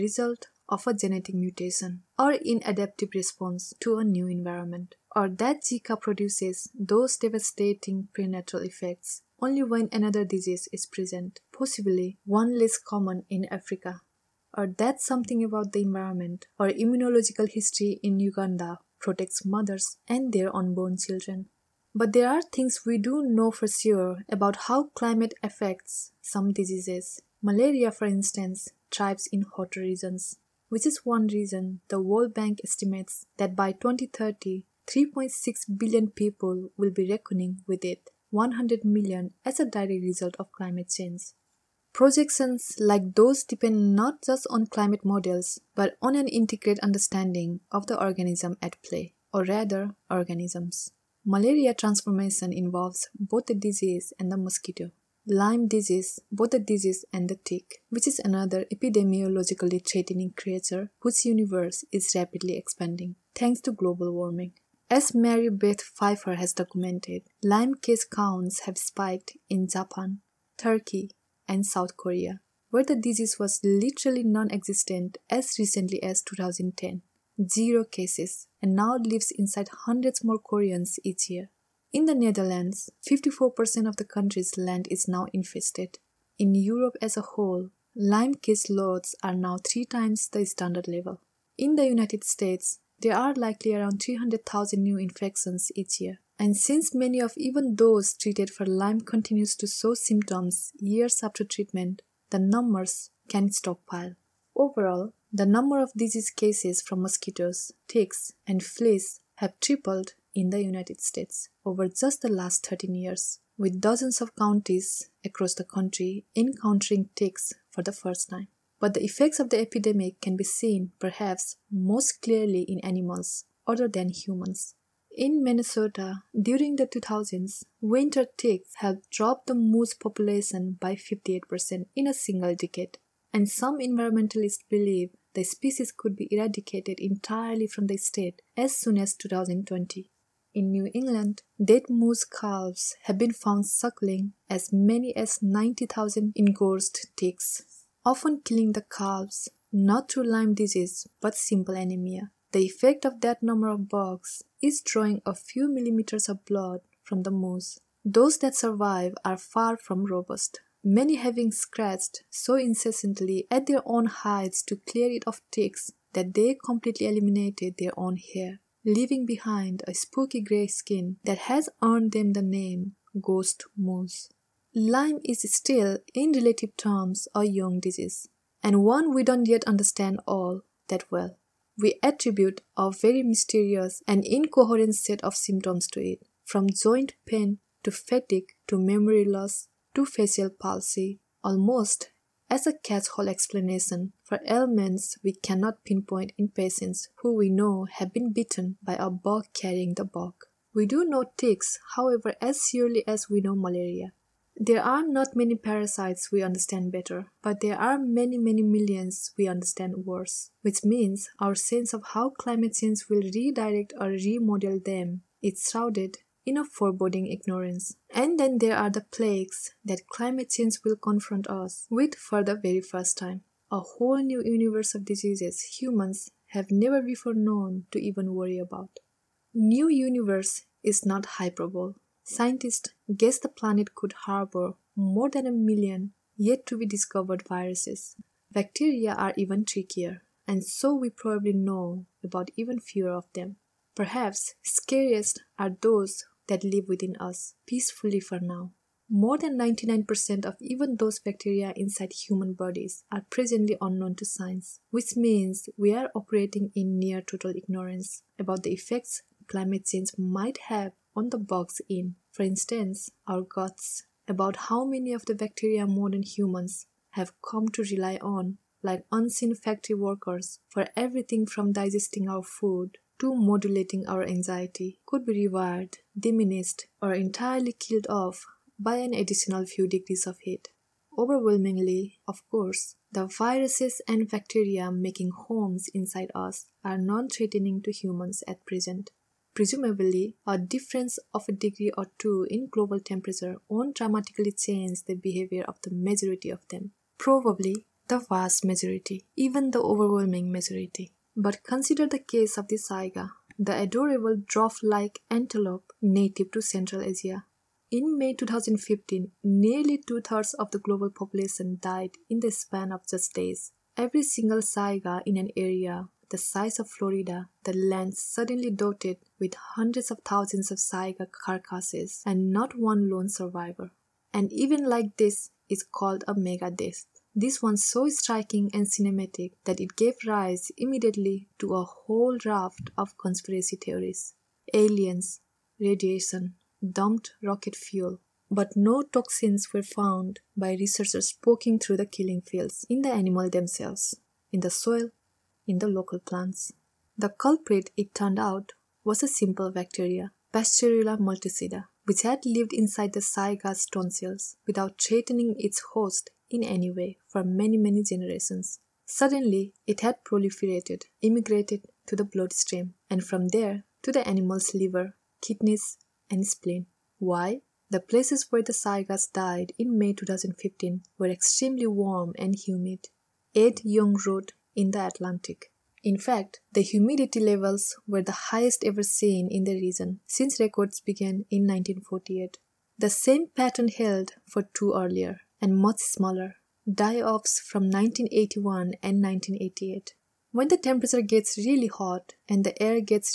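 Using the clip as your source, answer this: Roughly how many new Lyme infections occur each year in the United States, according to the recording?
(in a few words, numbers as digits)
300,000.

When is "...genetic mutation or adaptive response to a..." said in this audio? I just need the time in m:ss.
0:00.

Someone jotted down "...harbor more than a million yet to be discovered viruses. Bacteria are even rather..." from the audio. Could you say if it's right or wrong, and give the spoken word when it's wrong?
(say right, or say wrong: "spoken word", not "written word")
wrong: "trickier", not "rather".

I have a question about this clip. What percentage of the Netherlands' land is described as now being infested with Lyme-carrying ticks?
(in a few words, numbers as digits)
54%.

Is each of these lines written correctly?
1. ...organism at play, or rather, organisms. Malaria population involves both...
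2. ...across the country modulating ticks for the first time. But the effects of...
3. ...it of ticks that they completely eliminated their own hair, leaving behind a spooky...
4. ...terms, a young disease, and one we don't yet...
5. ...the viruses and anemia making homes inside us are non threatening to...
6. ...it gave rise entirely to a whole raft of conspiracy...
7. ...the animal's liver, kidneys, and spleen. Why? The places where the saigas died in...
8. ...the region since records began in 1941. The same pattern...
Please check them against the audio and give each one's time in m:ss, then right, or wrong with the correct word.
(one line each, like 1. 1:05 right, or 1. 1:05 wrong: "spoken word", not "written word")
1. 0:47 wrong: "transformation", not "population"
2. 1:55 wrong: "encountering", not "modulating"
3. 2:45 right
4. 2:56 right
5. 4:43 wrong: "bacteria", not "anemia"
6. 5:29 wrong: "immediately", not "entirely"
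7. 6:04 right
8. 6:19 wrong: "1948", not "1941".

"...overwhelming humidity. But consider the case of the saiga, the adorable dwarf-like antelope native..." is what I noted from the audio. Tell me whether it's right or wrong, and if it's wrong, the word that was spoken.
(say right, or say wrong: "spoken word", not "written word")
wrong: "majority", not "humidity".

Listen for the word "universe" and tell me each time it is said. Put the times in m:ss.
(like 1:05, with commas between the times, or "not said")
1:01, 3:44, 3:49.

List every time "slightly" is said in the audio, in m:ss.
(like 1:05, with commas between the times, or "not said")
not said.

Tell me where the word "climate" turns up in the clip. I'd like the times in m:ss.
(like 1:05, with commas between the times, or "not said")
0:24, 0:40, 0:44, 3:32, 3:40, 4:19.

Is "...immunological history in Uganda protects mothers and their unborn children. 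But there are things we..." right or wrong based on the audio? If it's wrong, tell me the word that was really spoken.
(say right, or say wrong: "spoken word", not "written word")
right.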